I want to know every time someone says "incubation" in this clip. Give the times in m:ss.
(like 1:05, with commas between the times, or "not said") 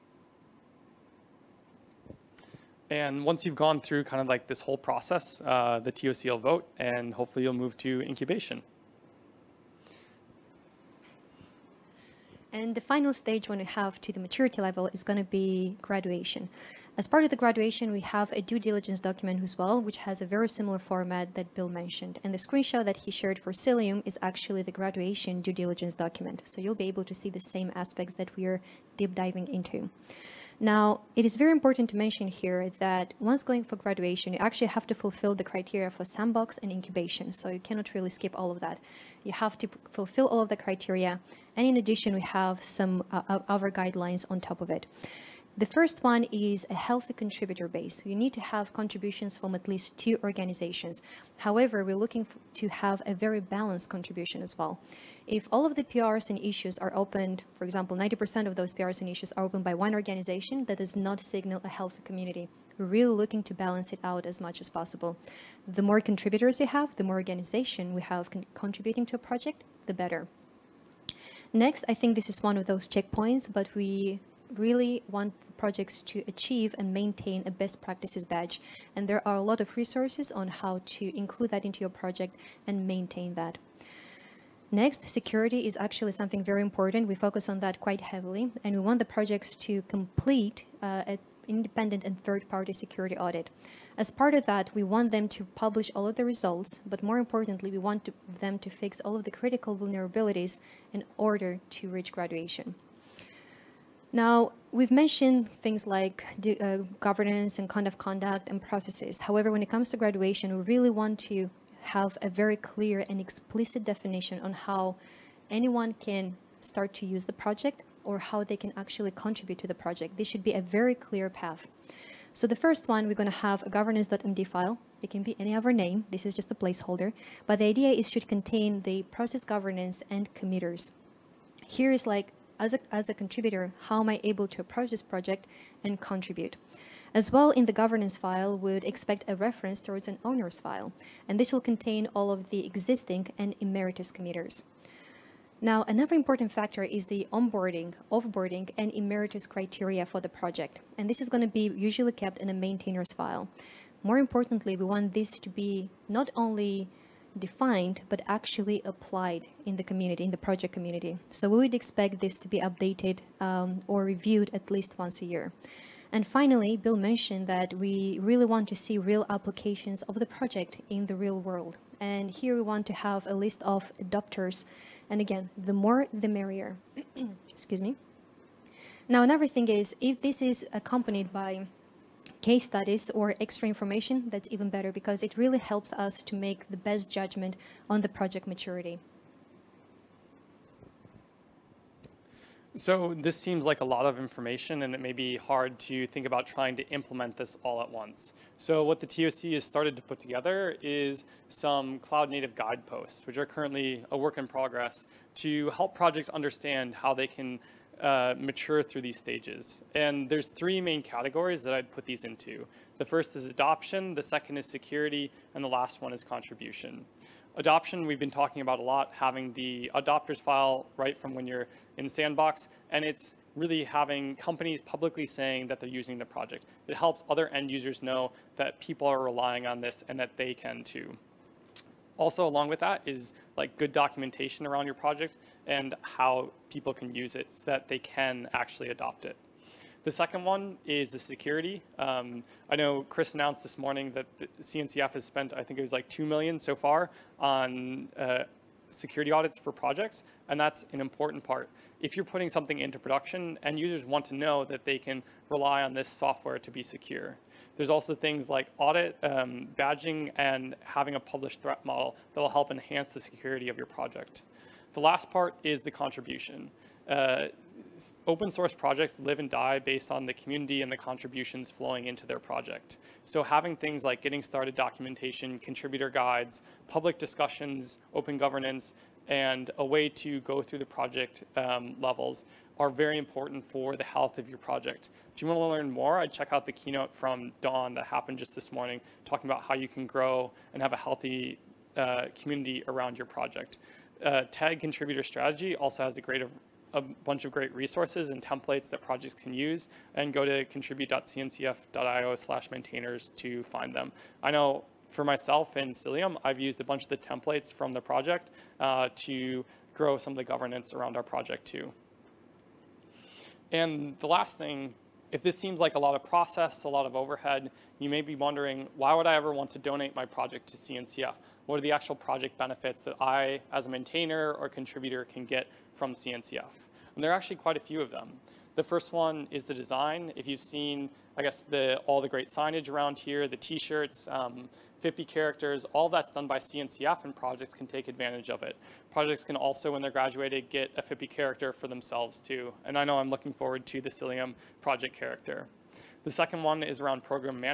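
0:08, 0:36.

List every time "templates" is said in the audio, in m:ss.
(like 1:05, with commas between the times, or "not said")
4:58, 5:07.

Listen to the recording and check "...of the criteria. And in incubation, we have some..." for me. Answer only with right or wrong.
wrong.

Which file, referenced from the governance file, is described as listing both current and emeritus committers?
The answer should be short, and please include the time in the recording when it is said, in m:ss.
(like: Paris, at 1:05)
owners file, at 2:20.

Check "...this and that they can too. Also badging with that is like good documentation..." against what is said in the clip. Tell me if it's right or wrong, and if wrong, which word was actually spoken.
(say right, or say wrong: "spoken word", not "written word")
wrong: "along", not "badging".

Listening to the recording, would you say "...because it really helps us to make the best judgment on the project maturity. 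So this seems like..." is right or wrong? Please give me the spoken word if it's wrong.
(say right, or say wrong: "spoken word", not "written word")
right.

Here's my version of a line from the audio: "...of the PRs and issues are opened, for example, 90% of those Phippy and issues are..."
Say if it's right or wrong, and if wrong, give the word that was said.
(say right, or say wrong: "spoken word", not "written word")
wrong: "PRs", not "Phippy".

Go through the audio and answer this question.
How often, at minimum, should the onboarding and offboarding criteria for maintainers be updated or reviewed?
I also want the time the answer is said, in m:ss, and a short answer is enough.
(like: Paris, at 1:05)
once a year, at 2:44.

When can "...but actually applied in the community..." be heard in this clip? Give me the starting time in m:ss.
2:38.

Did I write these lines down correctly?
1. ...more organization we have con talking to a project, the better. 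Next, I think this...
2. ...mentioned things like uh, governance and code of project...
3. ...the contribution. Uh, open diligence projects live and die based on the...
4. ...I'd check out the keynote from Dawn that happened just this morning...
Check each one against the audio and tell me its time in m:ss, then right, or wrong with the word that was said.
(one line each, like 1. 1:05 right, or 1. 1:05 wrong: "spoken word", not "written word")
1. 1:07 wrong: "contributing", not "talking"
2. 1:44 wrong: "conduct", not "project"
3. 4:25 wrong: "source", not "diligence"
4. 4:46 right.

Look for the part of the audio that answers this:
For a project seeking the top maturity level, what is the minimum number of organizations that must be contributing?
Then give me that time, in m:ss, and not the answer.
0:49.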